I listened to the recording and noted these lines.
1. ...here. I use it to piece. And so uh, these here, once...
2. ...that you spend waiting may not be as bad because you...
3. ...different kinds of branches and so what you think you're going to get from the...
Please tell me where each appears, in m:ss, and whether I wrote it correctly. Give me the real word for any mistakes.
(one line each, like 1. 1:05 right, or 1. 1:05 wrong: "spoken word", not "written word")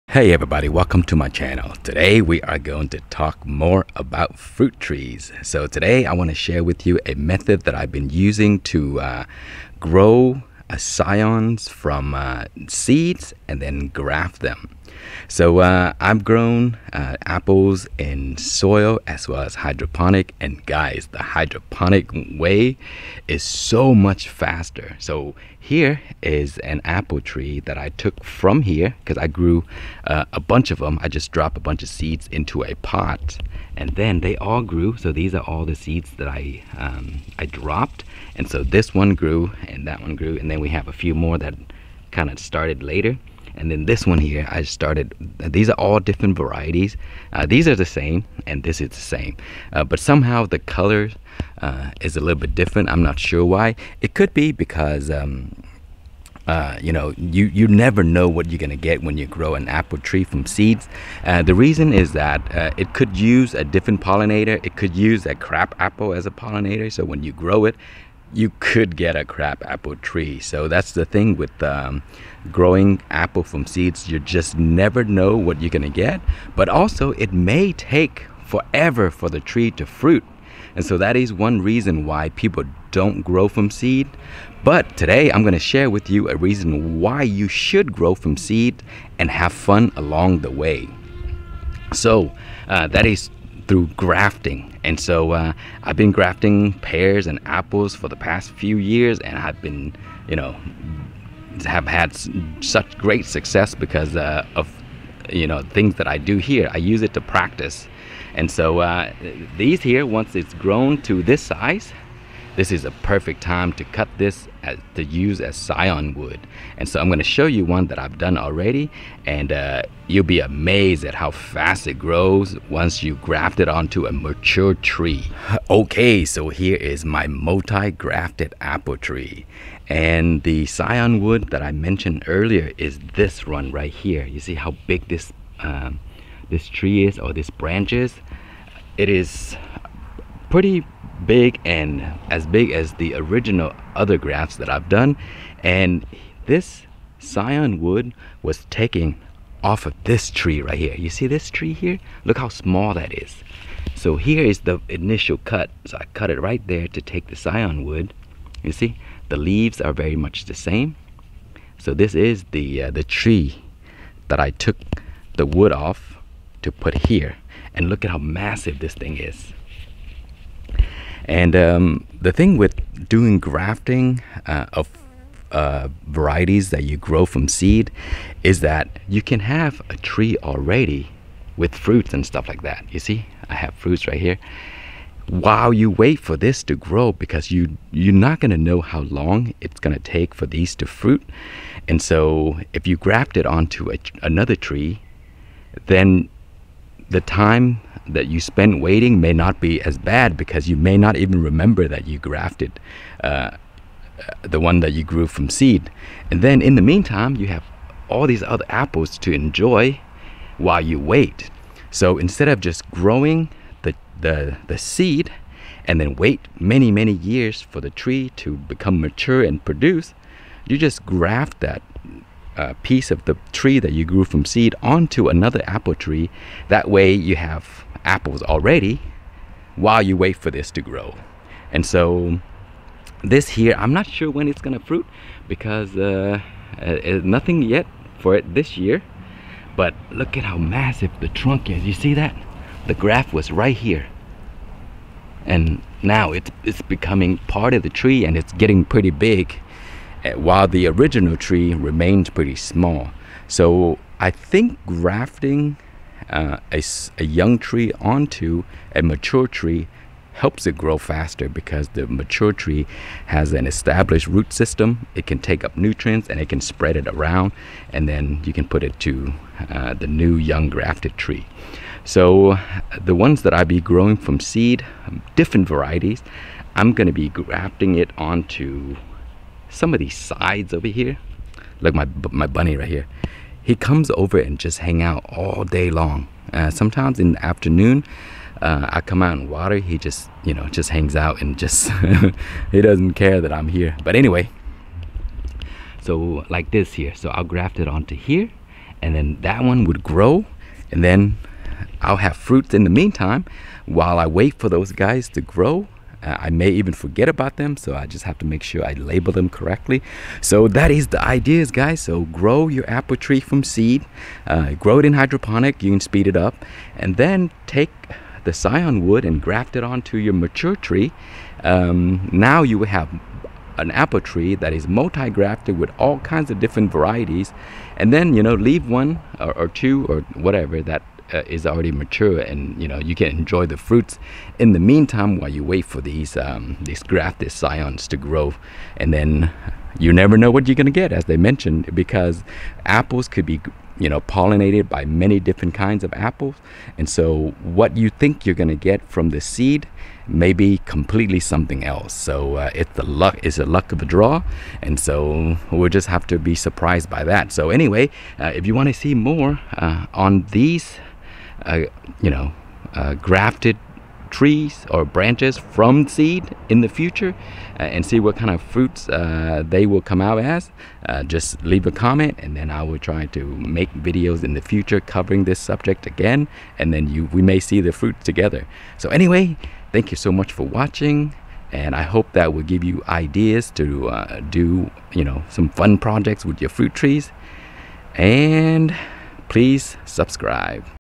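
1. 1:46 wrong: "practice", not "piece"
2. 3:18 right
3. 5:45 wrong: "apples", not "branches".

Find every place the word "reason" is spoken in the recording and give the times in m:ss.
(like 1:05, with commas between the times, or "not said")
1:01, 1:21, 1:26.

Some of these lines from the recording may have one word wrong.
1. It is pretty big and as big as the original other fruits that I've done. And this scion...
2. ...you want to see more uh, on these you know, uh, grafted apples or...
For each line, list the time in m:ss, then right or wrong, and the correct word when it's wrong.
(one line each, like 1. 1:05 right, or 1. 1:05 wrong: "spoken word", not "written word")
1. 2:18 wrong: "grafts", not "fruits"
2. 5:58 wrong: "trees", not "apples".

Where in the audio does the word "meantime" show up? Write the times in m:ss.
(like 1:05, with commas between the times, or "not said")
3:26, 5:02, 5:34.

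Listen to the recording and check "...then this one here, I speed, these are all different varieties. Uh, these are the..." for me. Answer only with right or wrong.
wrong.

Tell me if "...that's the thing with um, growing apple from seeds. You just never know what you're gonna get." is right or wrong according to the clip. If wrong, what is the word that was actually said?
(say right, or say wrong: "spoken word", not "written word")
right.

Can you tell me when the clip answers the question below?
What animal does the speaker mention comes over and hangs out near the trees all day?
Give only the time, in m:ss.
4:42.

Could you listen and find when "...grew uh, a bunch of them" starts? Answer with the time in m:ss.
0:29.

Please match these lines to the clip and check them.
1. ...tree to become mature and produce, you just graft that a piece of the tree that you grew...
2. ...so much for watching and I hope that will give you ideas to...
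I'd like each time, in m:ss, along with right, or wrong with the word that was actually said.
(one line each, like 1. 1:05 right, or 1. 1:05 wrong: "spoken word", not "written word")
1. 3:37 right
2. 6:20 right.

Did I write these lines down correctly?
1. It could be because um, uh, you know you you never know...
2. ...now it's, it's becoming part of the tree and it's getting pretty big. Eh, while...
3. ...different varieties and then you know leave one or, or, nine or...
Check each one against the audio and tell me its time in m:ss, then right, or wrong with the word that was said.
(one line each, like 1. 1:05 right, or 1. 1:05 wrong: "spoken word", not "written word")
1. 0:54 right
2. 4:06 right
3. 5:26 wrong: "two", not "nine".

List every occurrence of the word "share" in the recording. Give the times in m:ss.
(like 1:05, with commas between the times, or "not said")
0:06, 1:25.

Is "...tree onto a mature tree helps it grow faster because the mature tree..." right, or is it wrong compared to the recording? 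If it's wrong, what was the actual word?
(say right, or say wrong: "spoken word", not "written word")
right.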